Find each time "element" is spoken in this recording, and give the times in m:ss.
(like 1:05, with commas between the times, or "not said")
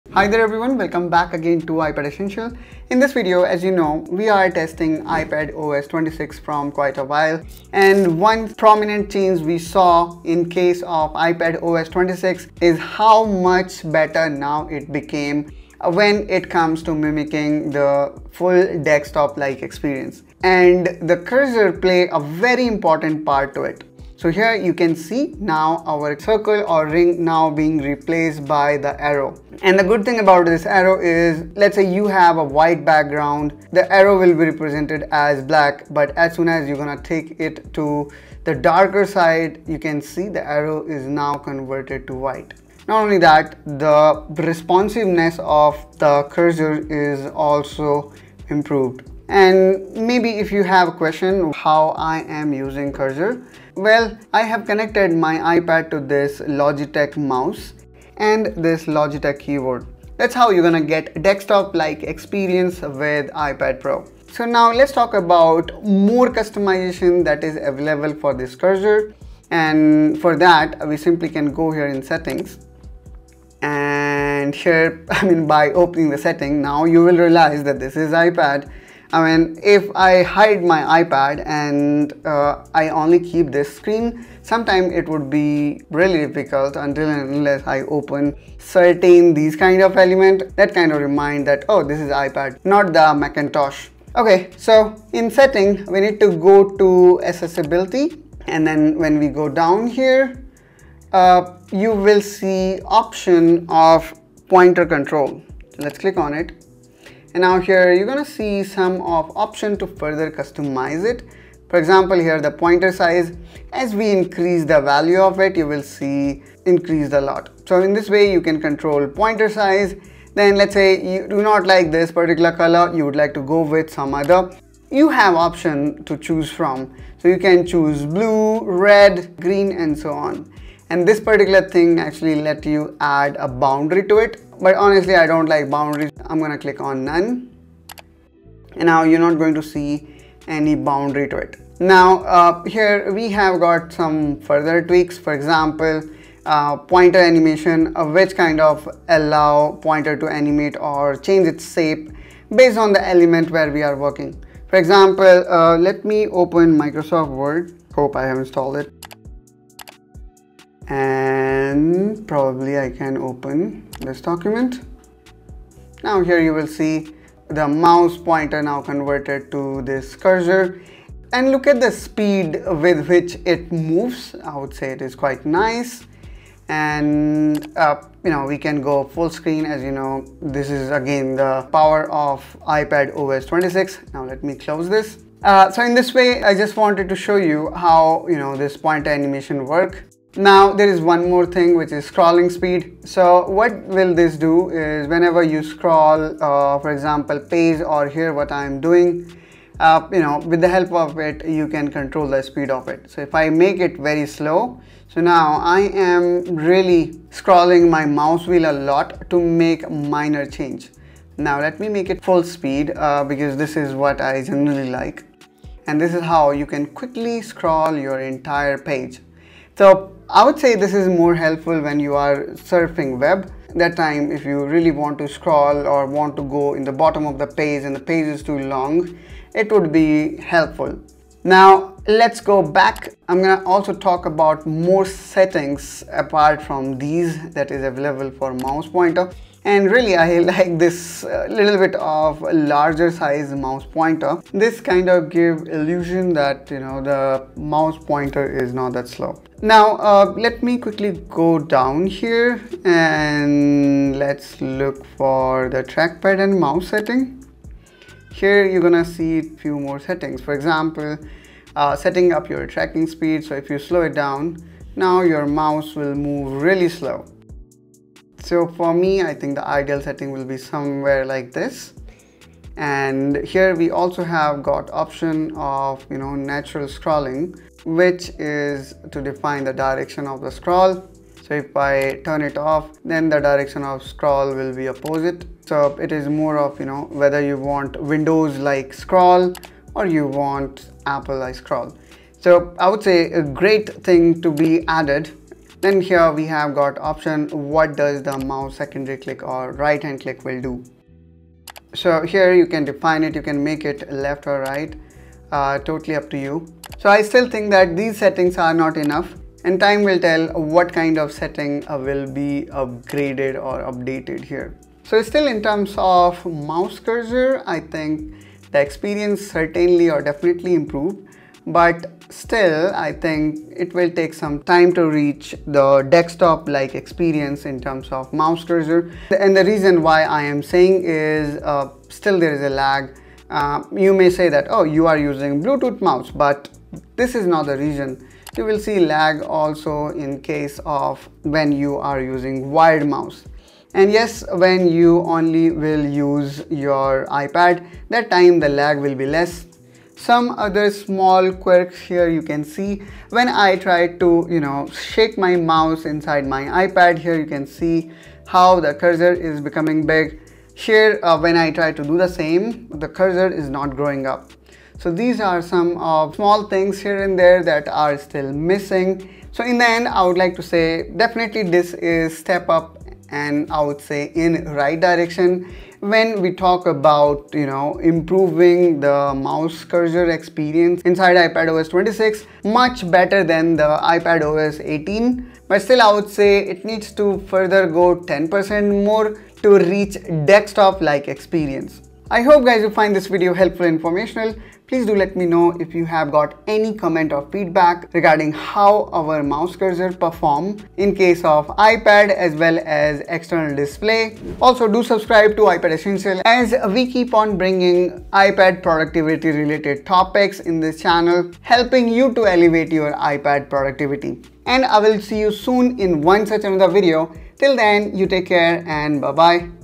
1:29, 2:33.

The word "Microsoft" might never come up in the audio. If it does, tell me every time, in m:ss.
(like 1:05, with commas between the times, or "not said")
2:36.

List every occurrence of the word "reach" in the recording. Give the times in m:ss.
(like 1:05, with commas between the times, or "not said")
5:25, 6:29.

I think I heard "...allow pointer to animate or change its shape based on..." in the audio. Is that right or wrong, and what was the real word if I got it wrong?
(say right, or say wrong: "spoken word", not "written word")
right.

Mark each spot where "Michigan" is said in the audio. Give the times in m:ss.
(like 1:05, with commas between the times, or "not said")
not said.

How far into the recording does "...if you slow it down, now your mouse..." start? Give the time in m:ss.
4:23.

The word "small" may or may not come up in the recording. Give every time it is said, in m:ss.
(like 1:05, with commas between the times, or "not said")
5:50, 6:06.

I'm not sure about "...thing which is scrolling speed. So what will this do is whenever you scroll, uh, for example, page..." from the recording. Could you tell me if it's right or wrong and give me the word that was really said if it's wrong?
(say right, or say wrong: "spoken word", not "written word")
right.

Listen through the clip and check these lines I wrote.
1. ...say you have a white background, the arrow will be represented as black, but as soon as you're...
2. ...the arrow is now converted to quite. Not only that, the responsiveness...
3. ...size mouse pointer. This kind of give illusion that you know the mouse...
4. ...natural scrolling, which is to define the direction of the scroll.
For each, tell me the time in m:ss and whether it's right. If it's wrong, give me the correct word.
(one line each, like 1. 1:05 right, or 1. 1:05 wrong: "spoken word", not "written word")
1. 0:31 right
2. 0:40 wrong: "white", not "quite"
3. 4:03 right
4. 4:36 right.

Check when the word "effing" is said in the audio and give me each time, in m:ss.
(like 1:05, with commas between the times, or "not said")
not said.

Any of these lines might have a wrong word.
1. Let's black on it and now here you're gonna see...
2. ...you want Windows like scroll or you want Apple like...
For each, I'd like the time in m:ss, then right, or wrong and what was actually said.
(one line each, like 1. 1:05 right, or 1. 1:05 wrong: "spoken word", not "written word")
1. 1:45 wrong: "click", not "black"
2. 4:47 right.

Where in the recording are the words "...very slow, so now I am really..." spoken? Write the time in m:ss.
3:23.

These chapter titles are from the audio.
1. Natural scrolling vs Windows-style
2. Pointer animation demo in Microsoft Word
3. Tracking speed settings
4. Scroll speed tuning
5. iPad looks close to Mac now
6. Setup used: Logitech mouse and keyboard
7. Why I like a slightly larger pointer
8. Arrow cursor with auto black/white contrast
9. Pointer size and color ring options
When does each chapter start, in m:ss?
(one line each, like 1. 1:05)
1. 4:31
2. 2:17
3. 4:09
4. 3:09
5. 1:04
6. 0:53
7. 3:50
8. 0:24
9. 1:47.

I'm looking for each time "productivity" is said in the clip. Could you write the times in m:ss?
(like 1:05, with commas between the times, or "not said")
6:48, 6:53.